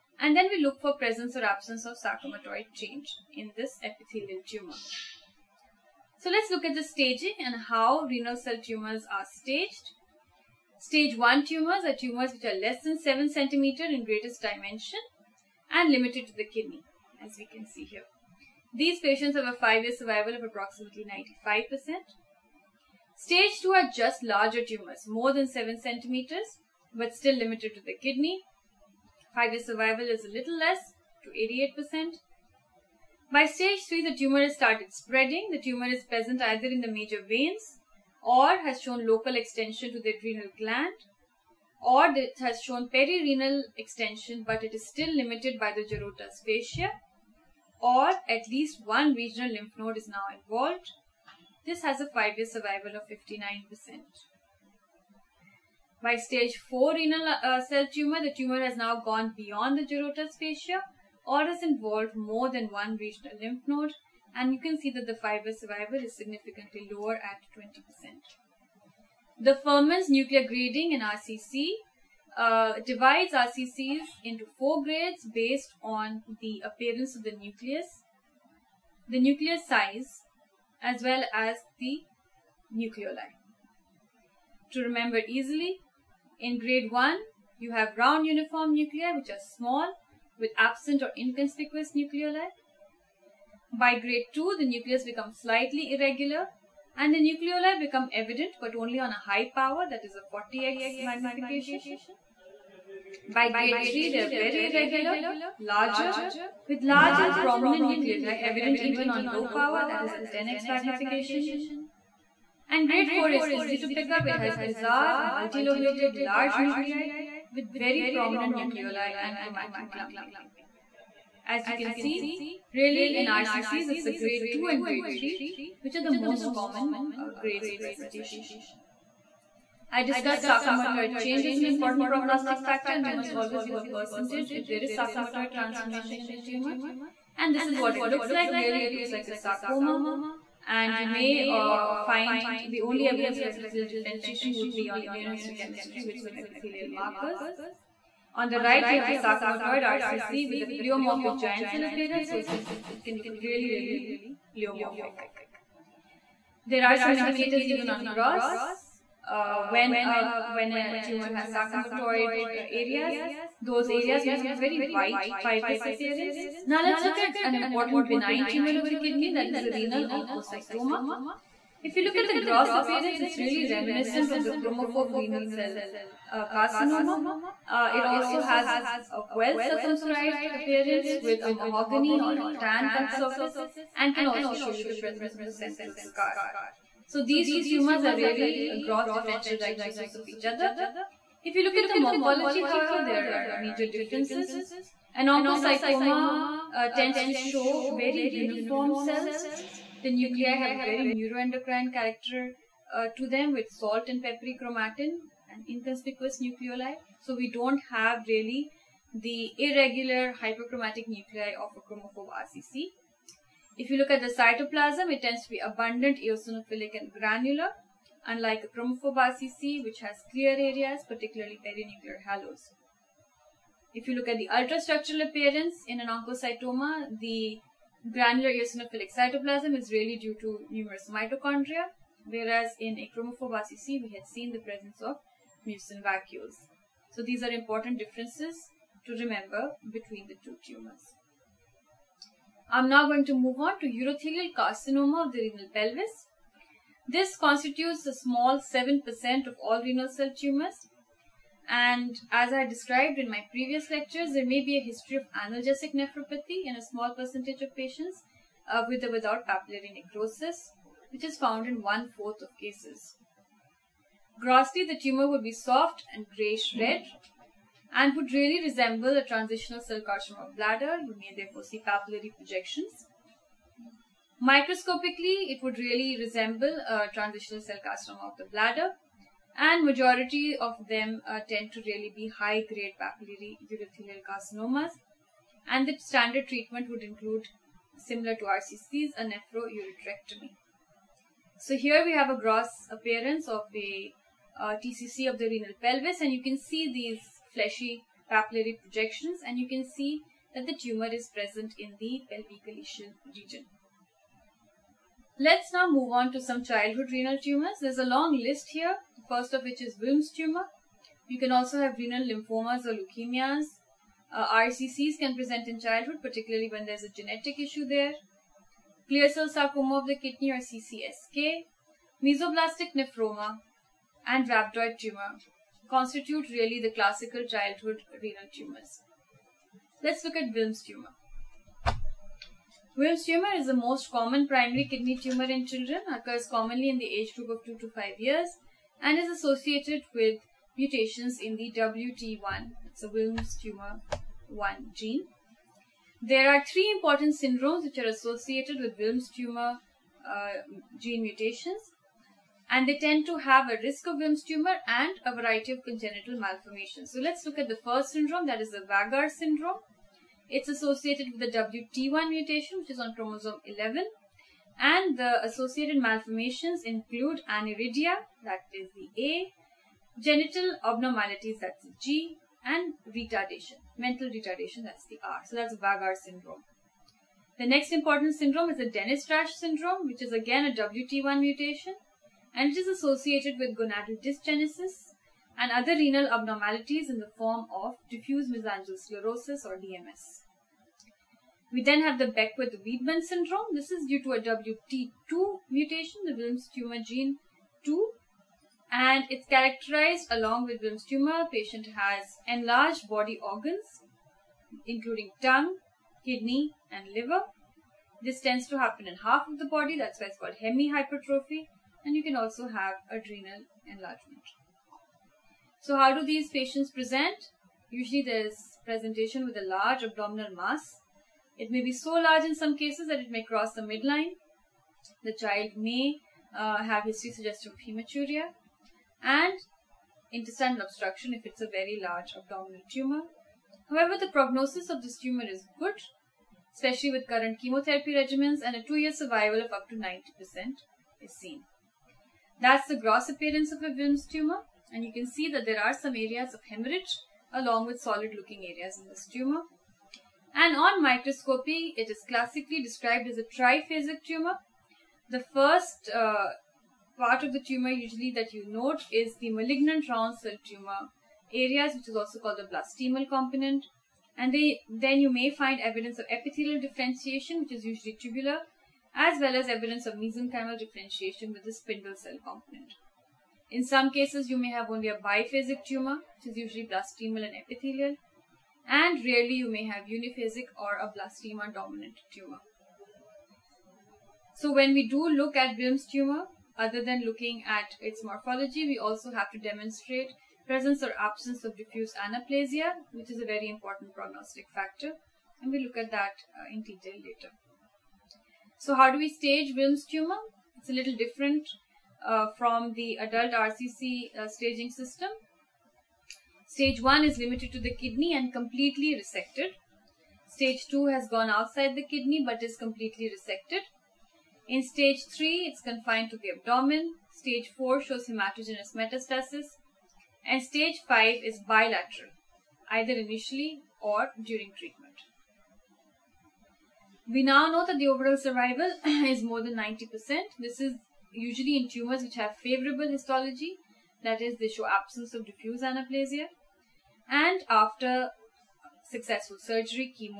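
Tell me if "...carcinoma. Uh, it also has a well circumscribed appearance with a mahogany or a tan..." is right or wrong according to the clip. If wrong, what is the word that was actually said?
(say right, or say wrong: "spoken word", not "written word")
right.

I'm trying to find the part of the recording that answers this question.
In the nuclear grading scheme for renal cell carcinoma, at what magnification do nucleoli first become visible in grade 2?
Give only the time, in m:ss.
1:40.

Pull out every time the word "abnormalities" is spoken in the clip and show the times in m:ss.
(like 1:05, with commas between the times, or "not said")
6:10, 6:26.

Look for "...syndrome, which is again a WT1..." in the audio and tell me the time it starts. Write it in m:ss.
6:19.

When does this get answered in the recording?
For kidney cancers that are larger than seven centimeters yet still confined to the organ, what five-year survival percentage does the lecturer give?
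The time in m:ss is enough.
0:31.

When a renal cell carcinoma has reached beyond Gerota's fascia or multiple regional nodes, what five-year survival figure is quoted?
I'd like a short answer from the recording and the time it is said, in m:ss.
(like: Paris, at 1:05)
20%, at 1:07.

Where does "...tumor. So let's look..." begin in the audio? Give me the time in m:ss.
0:04.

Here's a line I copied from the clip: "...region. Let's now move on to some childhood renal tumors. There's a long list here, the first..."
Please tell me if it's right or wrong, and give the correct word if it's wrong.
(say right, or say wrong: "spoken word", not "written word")
right.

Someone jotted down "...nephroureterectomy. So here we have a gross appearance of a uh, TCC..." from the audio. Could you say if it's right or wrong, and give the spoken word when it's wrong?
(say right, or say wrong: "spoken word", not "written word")
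right.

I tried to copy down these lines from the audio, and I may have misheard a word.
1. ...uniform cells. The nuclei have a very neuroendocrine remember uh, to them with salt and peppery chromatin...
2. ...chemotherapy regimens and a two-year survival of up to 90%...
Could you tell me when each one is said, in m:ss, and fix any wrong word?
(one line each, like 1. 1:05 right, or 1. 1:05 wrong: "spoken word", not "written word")
1. 3:18 wrong: "character", not "remember"
2. 7:17 right.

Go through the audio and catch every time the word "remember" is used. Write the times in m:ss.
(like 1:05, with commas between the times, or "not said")
1:24, 3:59.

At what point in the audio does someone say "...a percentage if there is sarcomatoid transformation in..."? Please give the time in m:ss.
2:13.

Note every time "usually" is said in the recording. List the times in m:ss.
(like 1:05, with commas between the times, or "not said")
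6:57, 7:37, 7:47, 7:56, 8:51.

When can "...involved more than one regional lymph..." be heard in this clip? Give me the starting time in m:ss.
1:01.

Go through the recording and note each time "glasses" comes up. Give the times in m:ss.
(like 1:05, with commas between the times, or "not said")
not said.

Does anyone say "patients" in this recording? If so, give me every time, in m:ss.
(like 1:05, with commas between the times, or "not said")
0:18, 4:17, 6:41, 6:56.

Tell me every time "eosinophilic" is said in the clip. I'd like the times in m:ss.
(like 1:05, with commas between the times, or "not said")
3:36, 3:48.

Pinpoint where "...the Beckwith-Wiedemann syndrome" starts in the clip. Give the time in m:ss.
6:32.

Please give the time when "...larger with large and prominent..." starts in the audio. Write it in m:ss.
1:45.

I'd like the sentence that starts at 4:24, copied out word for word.
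Grossly, the tumor would be soft and grayish-red and would really resemble a transitional cell carcinoma of bladder.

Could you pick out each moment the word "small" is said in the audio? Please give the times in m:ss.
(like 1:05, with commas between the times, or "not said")
1:29, 4:08, 4:16.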